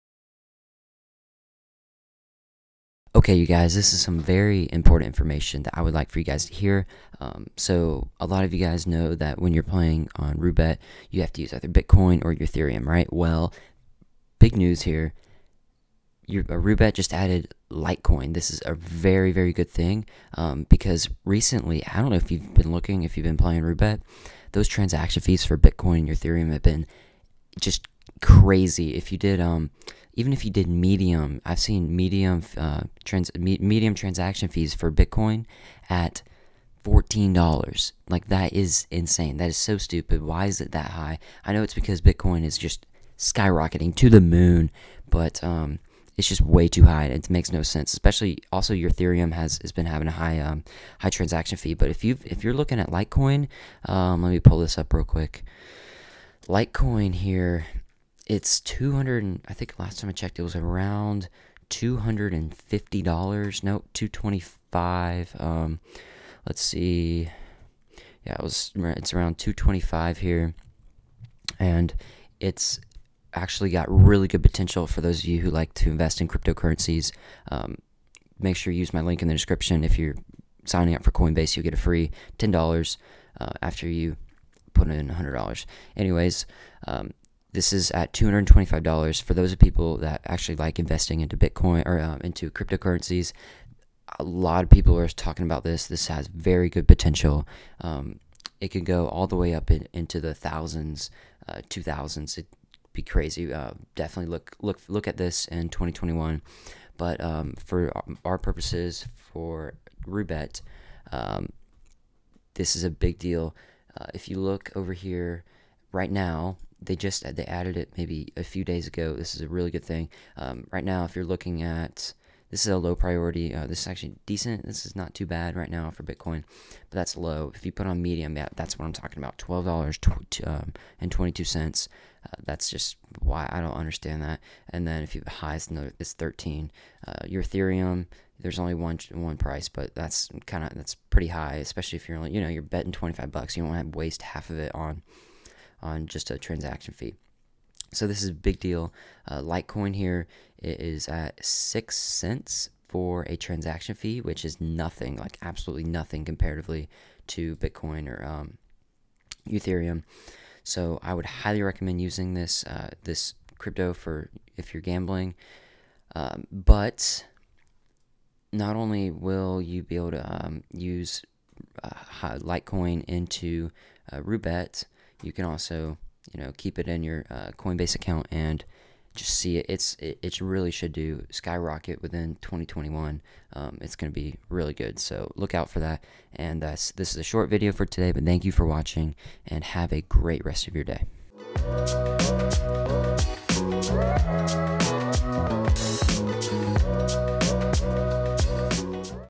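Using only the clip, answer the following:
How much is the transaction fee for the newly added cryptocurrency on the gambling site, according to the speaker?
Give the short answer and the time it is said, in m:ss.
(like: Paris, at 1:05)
6 cents, at 2:31.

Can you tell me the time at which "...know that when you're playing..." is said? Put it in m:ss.
0:08.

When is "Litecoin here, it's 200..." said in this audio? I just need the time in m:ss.
0:56.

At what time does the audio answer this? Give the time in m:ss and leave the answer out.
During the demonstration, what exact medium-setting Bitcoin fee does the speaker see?
2:09.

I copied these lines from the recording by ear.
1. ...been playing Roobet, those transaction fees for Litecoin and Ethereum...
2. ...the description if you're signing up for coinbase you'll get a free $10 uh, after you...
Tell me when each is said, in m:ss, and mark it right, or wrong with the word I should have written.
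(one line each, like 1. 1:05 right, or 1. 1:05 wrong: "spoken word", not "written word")
1. 0:23 wrong: "Bitcoin", not "Litecoin"
2. 1:19 right.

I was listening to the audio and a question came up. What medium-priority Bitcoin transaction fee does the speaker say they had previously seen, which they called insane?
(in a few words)
$14.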